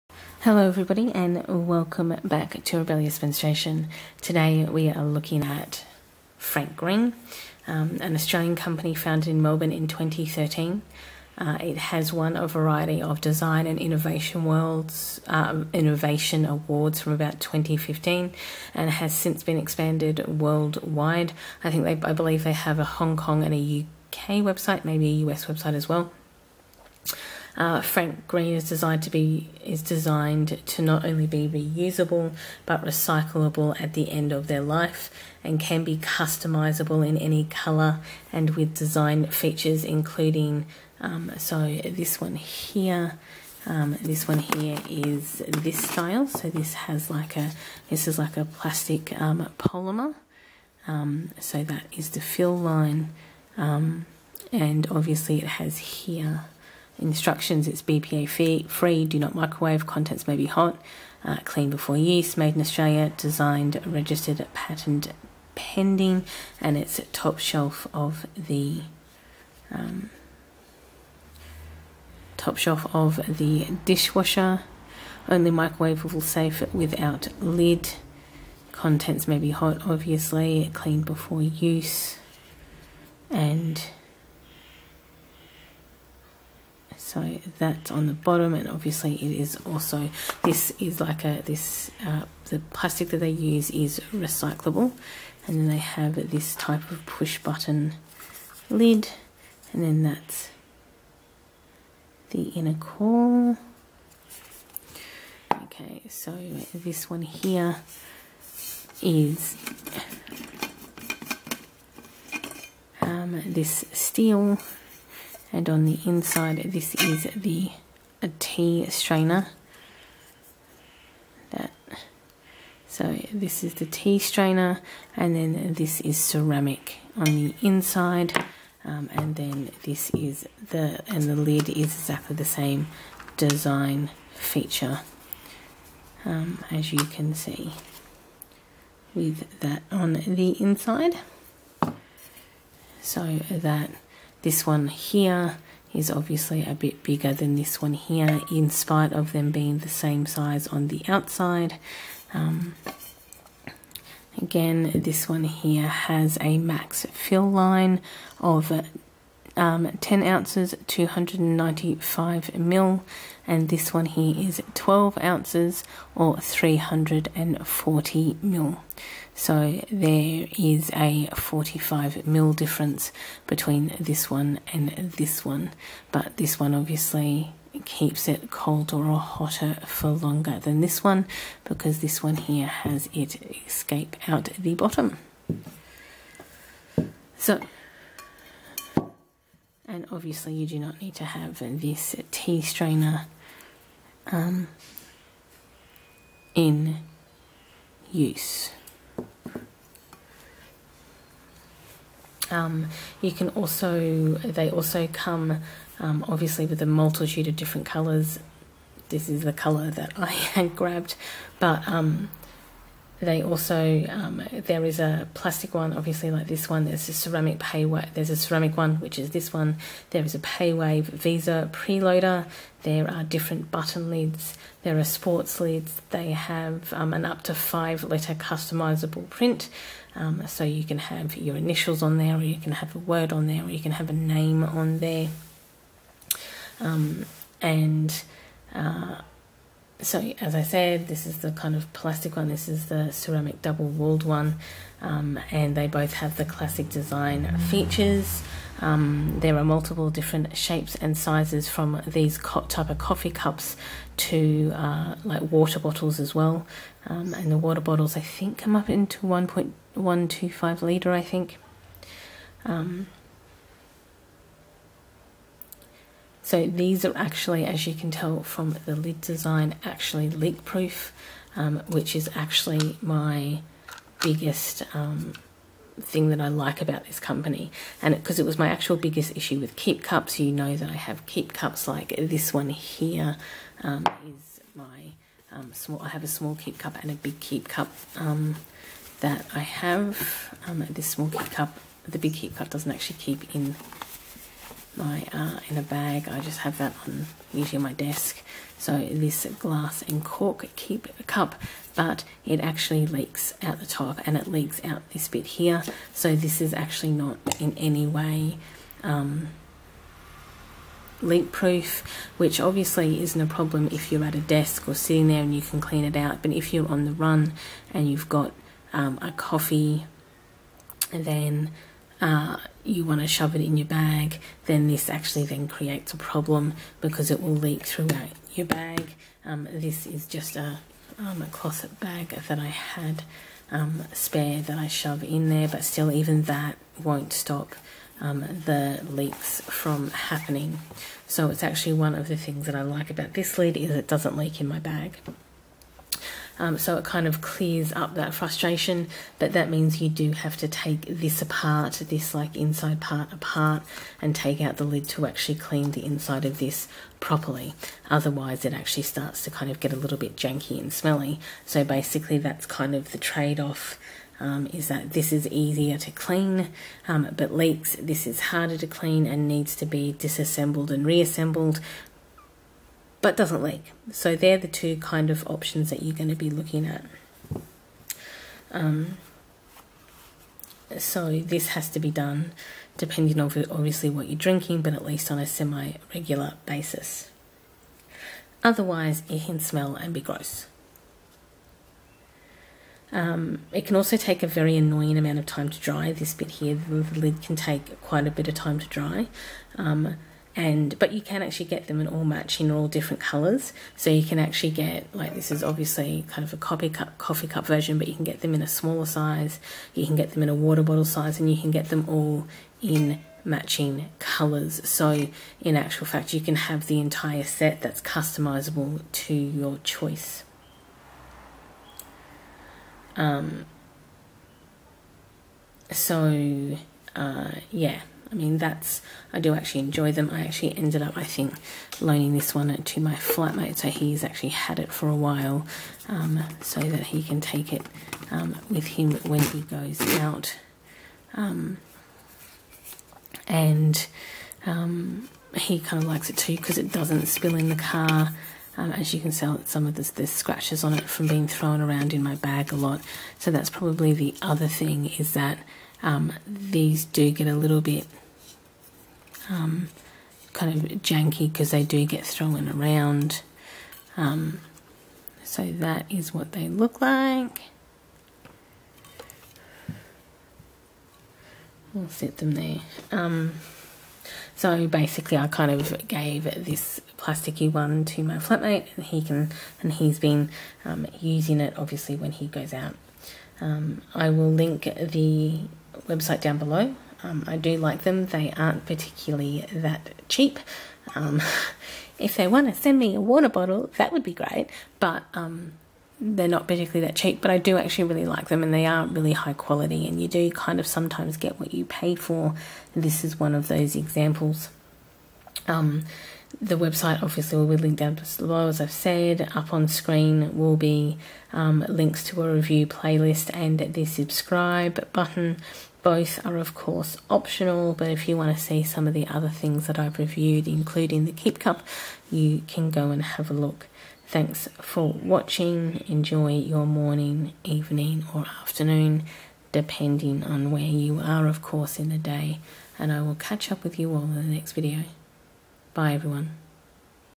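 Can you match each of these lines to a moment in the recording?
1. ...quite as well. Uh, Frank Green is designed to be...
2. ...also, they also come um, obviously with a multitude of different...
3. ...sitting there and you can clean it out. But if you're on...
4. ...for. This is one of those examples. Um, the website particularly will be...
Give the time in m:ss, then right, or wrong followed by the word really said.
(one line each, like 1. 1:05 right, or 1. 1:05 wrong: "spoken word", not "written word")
1. 0:25 wrong: "website", not "quite"
2. 3:23 right
3. 5:14 right
4. 8:22 wrong: "obviously", not "particularly".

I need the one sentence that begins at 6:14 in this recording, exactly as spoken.
So they're the two kind of options that you're going to be looking at.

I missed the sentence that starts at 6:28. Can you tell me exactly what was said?
Otherwise, it can smell and be gross.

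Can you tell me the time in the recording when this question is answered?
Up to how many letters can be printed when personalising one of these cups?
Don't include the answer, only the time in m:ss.
3:47.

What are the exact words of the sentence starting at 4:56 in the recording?
I just have that on usually my desk.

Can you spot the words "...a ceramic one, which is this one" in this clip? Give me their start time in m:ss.
3:38.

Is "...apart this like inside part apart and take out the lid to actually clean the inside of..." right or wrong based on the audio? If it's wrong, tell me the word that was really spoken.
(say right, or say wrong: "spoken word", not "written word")
right.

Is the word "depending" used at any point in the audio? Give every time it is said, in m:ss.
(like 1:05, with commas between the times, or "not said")
6:22, 8:49.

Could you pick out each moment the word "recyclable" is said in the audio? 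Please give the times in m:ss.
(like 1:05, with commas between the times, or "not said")
0:32, 1:34.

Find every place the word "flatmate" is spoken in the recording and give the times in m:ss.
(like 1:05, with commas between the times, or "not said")
7:13, 7:58.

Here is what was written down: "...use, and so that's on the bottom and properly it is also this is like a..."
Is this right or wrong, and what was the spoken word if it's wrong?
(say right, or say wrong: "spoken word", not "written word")
wrong: "obviously", not "properly".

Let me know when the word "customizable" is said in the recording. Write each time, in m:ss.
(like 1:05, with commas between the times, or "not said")
0:35, 3:48, 6:58.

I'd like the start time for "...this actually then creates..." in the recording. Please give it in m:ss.
5:24.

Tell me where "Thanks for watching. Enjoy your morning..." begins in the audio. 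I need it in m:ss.
8:44.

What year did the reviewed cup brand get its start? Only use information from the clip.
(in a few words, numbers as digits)
2013.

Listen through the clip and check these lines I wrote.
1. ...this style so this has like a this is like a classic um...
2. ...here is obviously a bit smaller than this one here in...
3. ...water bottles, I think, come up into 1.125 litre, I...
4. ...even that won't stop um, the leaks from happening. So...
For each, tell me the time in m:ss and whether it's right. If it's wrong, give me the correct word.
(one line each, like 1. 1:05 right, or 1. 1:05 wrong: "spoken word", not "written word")
1. 0:45 wrong: "plastic", not "classic"
2. 2:24 wrong: "bigger", not "smaller"
3. 4:17 right
4. 5:36 right.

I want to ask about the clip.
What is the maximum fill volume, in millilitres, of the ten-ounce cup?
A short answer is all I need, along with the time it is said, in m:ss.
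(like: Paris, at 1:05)
295 ml, at 2:40.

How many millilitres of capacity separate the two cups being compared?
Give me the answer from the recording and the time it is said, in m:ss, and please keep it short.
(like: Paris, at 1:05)
45 ml, at 2:51.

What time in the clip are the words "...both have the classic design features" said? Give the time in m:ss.
4:05.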